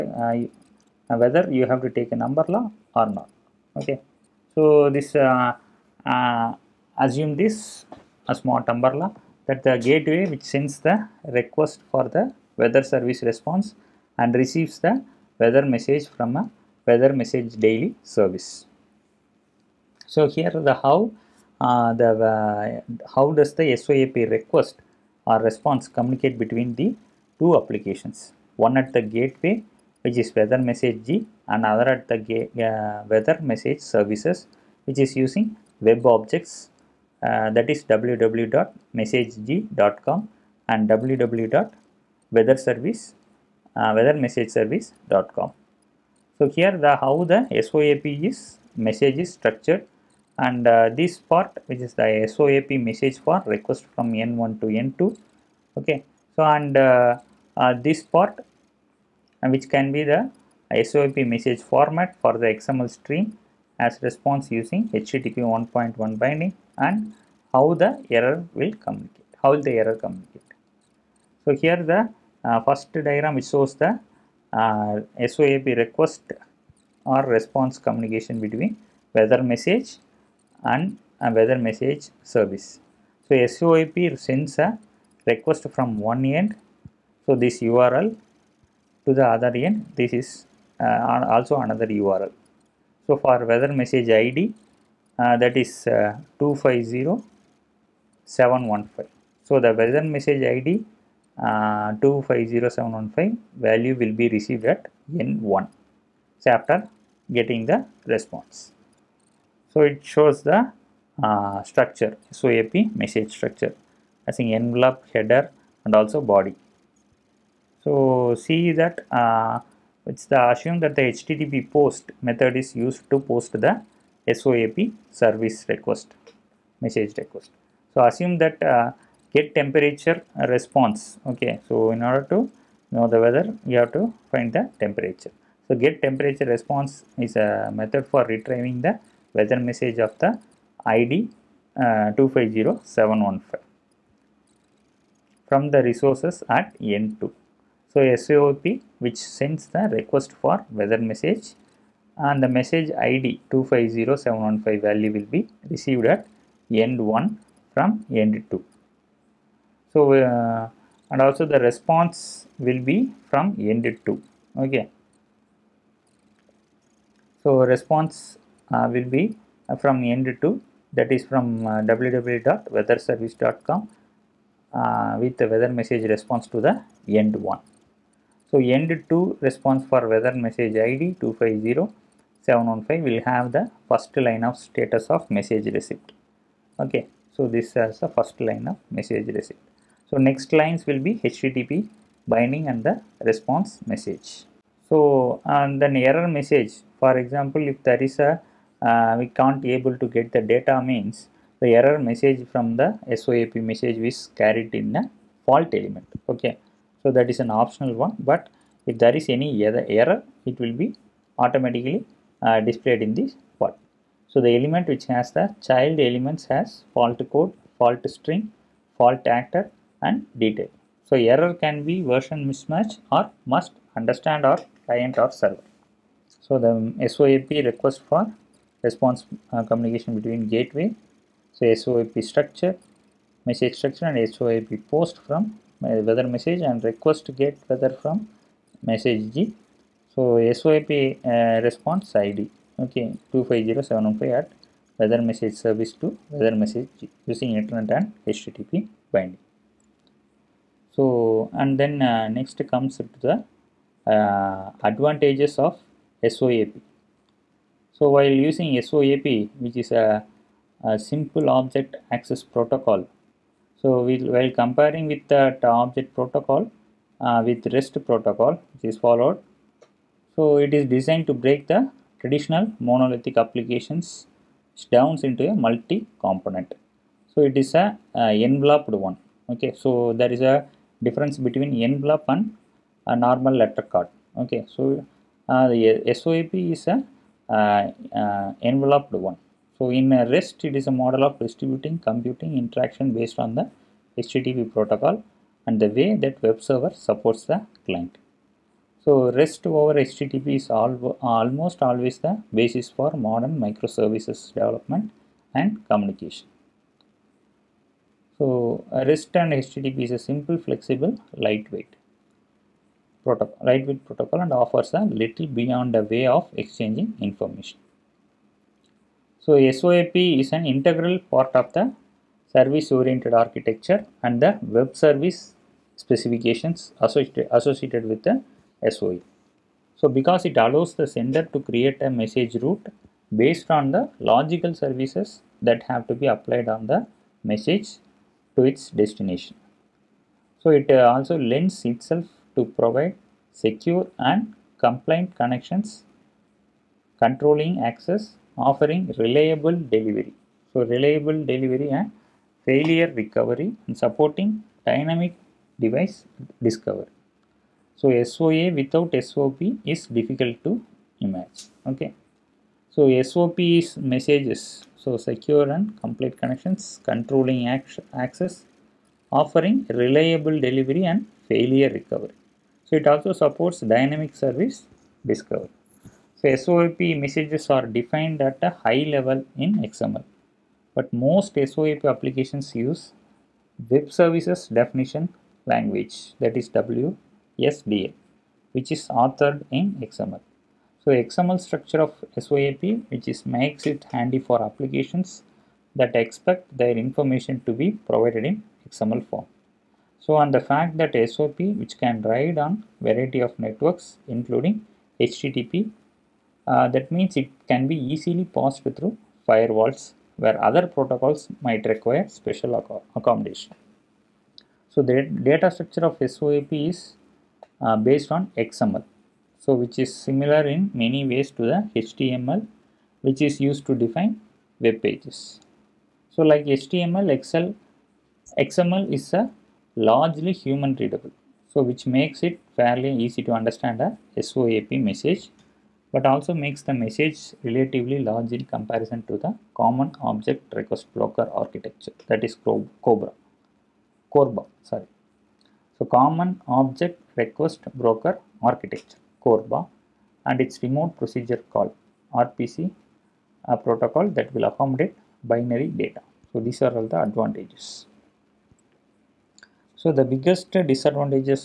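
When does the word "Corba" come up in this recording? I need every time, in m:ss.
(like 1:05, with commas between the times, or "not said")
7:24, 7:29.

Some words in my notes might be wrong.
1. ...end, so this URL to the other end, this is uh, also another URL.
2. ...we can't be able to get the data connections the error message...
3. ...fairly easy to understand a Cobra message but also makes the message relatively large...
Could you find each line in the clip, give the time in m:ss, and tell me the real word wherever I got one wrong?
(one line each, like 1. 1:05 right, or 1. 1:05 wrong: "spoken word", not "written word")
1. 1:26 right
2. 3:19 wrong: "means", not "connections"
3. 7:12 wrong: "SOAP", not "Cobra".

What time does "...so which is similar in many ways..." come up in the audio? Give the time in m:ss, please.
6:59.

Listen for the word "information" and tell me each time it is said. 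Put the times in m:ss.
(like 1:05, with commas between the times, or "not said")
5:17, 6:37.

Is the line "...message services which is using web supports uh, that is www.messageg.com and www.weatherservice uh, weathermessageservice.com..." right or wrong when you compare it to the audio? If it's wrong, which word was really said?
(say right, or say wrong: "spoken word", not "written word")
wrong: "objects", not "supports".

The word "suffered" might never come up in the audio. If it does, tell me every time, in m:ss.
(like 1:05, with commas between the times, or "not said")
not said.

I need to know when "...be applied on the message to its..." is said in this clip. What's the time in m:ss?
5:36.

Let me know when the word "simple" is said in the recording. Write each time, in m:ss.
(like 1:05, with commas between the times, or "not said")
4:20, 5:10.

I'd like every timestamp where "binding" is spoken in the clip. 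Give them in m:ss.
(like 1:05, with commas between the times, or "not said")
1:06, 3:12, 4:09.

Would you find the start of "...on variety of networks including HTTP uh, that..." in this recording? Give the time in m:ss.
6:42.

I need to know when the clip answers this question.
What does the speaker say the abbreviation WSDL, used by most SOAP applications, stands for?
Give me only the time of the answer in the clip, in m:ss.
6:23.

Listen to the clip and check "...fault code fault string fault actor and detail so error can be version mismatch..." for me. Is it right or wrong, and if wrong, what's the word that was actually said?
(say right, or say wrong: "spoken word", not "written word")
right.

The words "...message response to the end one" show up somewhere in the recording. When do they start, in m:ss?
2:55.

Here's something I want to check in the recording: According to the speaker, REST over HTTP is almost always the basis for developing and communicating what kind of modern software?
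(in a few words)
Microservices.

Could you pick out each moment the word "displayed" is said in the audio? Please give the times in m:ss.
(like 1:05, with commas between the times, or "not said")
3:32.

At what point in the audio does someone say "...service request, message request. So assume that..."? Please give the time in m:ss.
2:05.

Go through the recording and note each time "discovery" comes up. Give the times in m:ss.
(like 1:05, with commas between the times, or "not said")
5:56, 6:15.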